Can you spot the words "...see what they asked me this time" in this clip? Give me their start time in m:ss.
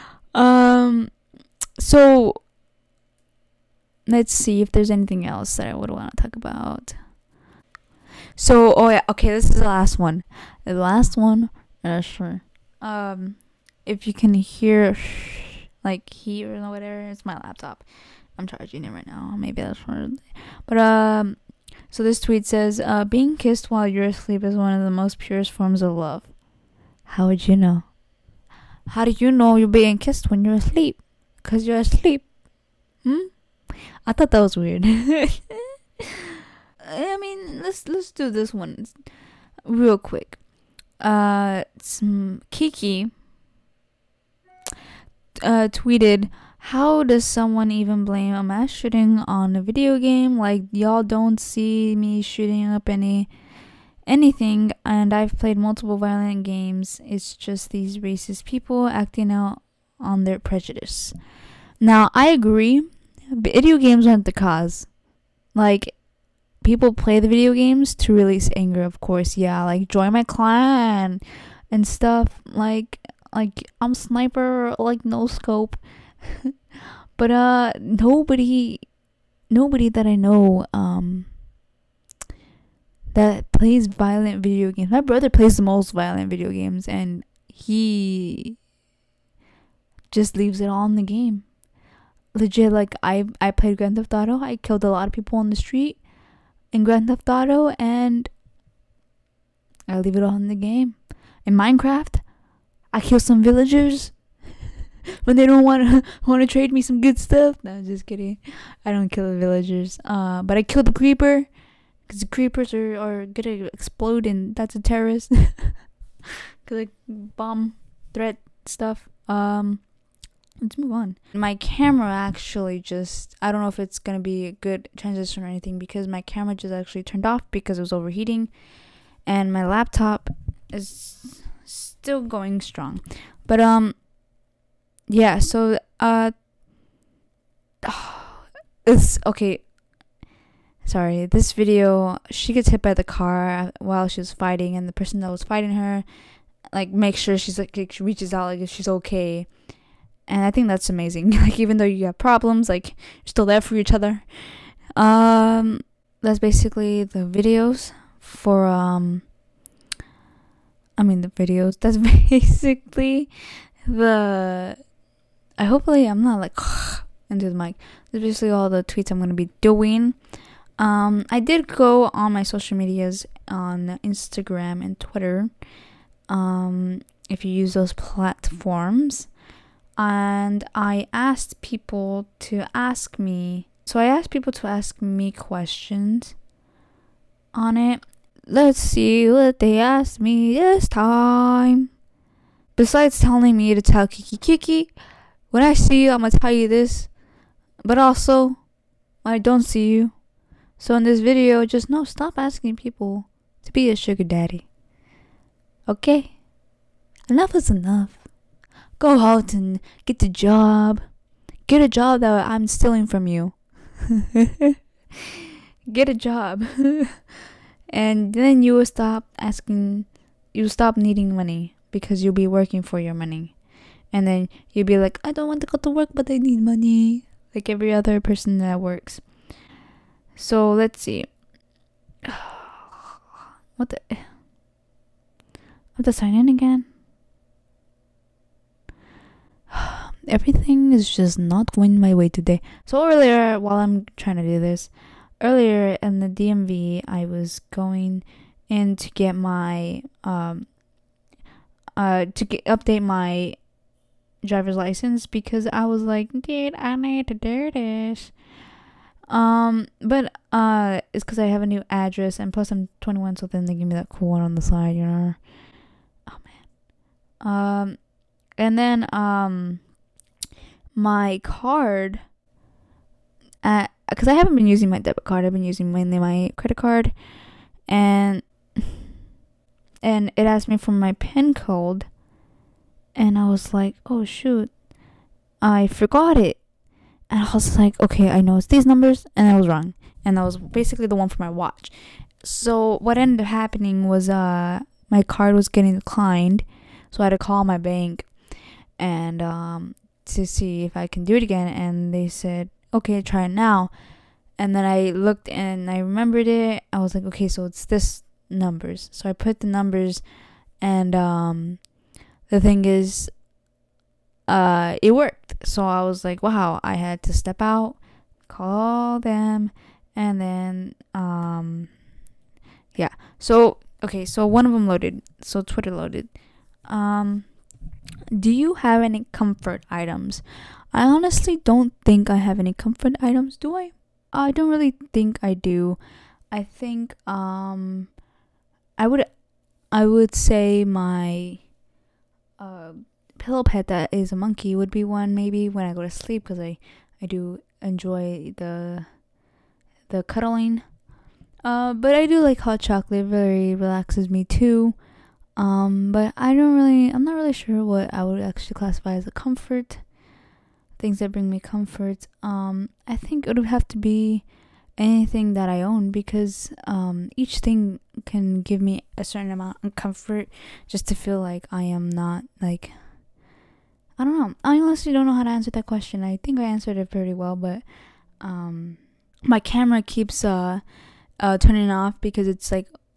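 3:08.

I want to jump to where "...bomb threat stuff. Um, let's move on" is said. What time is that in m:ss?
1:57.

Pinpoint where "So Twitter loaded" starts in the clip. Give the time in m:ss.
5:25.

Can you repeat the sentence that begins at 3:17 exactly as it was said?
But also, I don't see you.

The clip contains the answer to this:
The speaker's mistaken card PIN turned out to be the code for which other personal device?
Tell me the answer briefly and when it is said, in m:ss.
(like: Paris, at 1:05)
watch, at 4:51.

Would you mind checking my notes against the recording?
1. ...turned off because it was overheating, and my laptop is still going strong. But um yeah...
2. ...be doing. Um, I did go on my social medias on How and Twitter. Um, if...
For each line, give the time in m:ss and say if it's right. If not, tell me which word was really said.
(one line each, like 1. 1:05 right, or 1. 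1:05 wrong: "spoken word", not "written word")
1. 2:07 right
2. 2:49 wrong: "Instagram", not "How".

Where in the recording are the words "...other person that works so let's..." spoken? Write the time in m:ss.
3:47.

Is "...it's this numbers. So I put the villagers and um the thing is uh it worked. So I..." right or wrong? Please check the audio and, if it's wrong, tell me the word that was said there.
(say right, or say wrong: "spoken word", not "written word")
wrong: "numbers", not "villagers".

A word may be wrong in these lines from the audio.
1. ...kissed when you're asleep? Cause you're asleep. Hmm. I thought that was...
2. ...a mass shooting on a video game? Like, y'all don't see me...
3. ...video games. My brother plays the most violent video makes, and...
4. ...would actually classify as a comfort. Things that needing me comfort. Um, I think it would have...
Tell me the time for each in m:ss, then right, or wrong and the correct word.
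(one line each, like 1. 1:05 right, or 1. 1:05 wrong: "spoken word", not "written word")
1. 0:29 right
2. 0:48 right
3. 1:24 wrong: "games", not "makes"
4. 5:58 wrong: "bring", not "needing".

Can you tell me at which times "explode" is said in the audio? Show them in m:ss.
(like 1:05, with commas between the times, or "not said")
1:53.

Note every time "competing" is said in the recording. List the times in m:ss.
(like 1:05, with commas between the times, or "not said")
not said.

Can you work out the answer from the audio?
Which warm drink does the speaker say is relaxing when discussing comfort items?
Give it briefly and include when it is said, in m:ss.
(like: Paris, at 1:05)
hot chocolate, at 5:52.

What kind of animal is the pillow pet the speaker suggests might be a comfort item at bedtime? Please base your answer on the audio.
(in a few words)
monkey.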